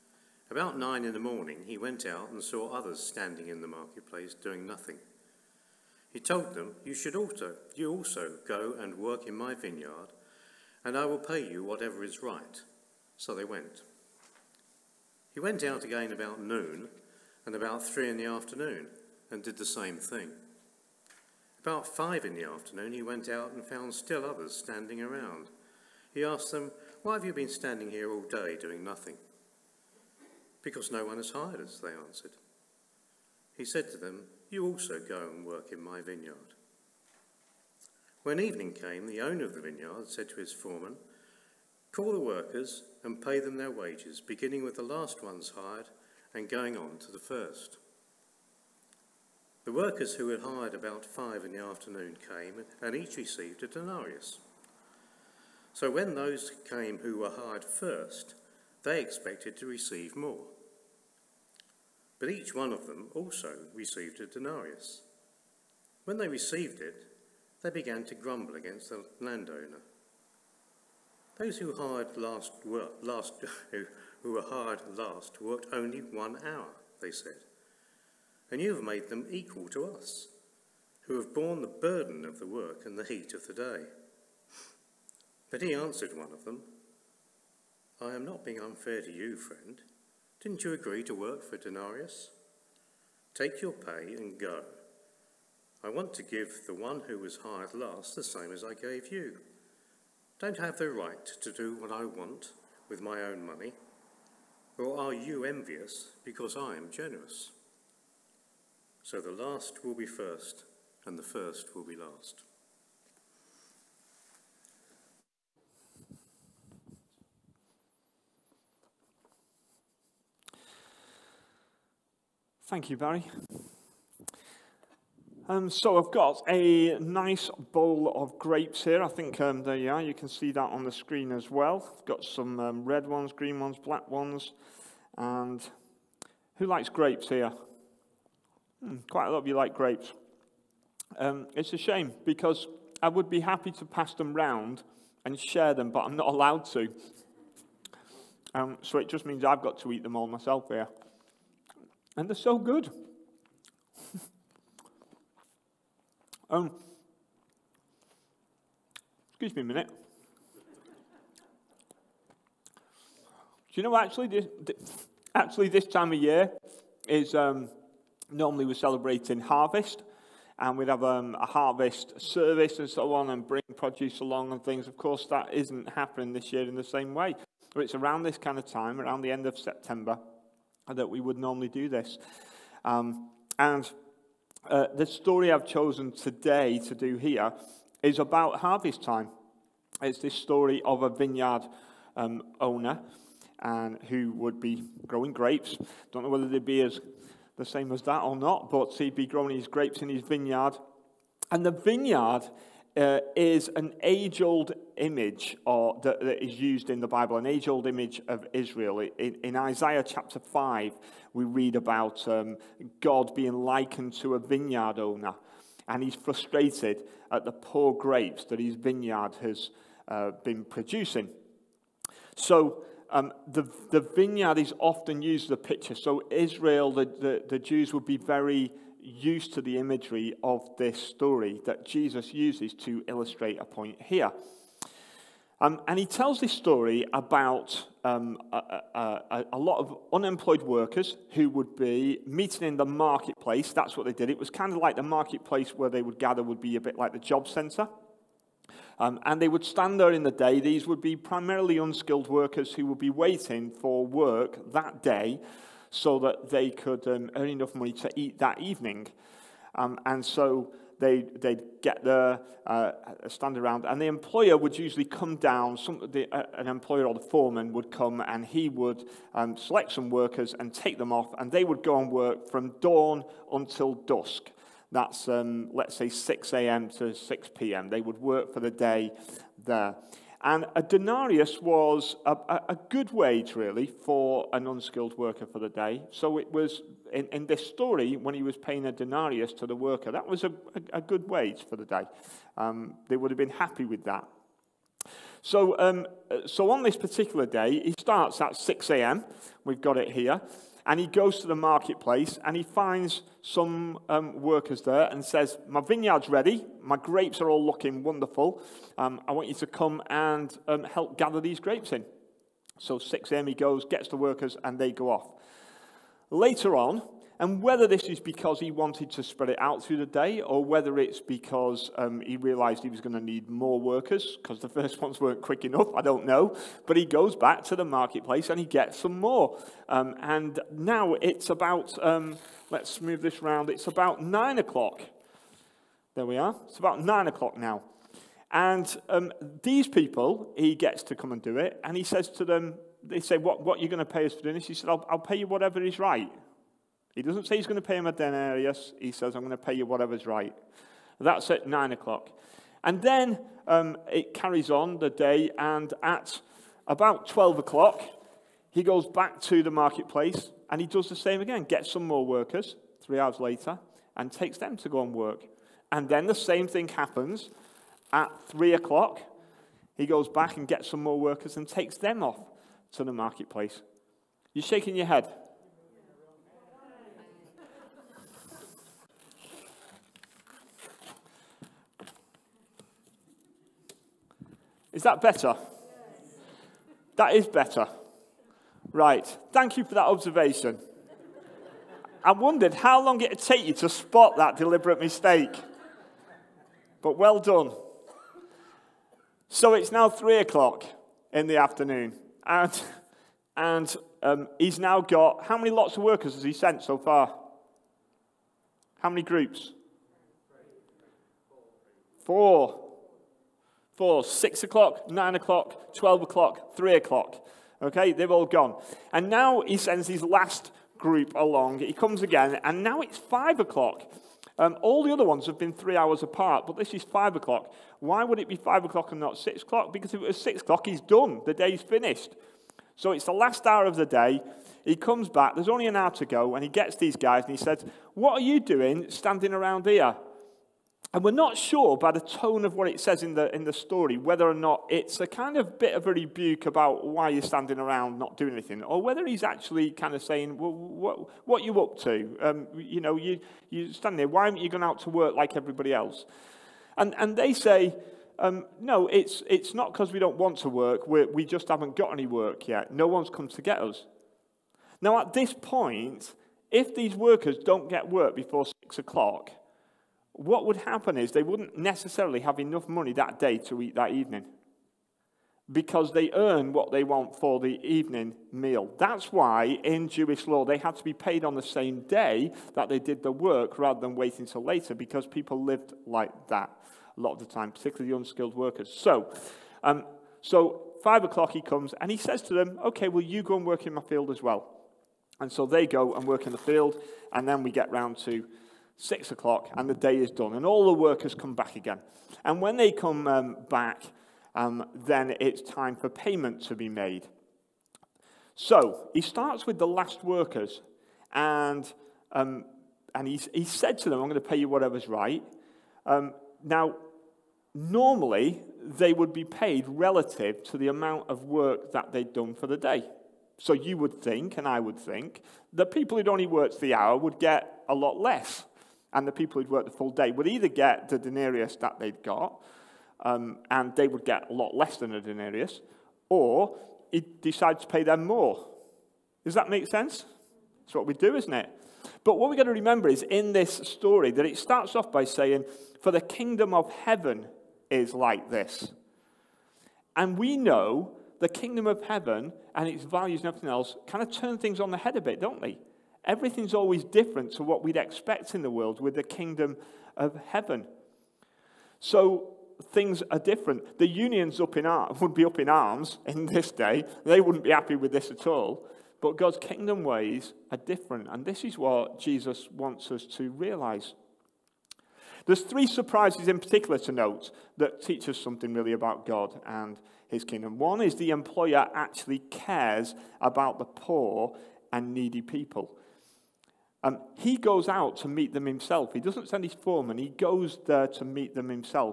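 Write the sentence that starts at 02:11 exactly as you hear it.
I've got some um, red ones, green ones, black ones.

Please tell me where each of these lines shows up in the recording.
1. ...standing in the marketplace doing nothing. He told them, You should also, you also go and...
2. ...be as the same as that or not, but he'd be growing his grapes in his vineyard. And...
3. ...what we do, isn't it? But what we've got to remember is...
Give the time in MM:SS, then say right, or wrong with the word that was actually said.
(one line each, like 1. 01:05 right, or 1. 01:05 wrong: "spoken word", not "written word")
1. 00:02 right
2. 03:16 right
3. 09:00 right.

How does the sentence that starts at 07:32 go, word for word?
Um, you know, you, you stand there, why haven't you gone out to work like everybody else?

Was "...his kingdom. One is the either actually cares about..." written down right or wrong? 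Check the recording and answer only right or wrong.
wrong.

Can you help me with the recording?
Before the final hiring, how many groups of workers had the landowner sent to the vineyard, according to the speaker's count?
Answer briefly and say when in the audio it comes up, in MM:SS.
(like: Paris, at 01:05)
4, at 06:52.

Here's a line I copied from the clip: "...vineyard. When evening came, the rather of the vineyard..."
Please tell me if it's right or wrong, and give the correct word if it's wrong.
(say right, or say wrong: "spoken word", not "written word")
wrong: "owner", not "rather".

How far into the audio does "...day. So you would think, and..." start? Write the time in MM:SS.
08:42.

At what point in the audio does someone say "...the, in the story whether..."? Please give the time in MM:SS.
07:23.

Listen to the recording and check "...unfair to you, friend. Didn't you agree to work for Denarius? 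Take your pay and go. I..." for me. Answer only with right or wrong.
right.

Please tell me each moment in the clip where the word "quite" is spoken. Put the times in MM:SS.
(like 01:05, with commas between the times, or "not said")
02:19.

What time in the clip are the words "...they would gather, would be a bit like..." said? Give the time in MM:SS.
04:05.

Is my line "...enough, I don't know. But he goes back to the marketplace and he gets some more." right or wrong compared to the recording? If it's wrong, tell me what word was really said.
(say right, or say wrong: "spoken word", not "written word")
right.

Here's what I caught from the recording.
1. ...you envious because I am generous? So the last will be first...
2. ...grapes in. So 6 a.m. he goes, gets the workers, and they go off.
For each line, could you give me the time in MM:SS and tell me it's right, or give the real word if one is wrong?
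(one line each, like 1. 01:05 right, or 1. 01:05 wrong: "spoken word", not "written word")
1. 01:45 right
2. 05:11 right.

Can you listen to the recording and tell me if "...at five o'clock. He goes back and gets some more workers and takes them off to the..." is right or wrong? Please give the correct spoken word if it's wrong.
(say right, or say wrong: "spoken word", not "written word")
wrong: "three", not "five".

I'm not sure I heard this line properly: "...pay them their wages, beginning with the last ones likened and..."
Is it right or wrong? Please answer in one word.
wrong.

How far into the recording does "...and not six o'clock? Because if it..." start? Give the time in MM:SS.
07:09.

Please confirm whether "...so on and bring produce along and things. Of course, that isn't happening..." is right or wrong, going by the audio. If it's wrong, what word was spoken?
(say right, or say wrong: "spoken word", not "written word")
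right.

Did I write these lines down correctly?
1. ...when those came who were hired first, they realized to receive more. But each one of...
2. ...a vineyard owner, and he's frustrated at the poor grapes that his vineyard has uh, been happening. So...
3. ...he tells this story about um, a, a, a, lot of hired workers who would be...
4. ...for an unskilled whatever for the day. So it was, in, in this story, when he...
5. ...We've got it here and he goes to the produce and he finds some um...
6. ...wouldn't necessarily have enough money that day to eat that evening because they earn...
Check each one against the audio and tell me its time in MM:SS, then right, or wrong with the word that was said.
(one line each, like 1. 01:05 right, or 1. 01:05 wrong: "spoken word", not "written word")
1. 00:55 wrong: "expected", not "realized"
2. 03:34 wrong: "producing", not "happening"
3. 03:55 wrong: "unemployed", not "hired"
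4. 04:43 wrong: "worker", not "whatever"
5. 04:59 wrong: "marketplace", not "produce"
6. 07:51 right.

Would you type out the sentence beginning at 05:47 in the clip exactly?
He doesn't say he's going to pay him a denarius.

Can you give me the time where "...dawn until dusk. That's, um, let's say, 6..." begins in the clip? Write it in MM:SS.
04:32.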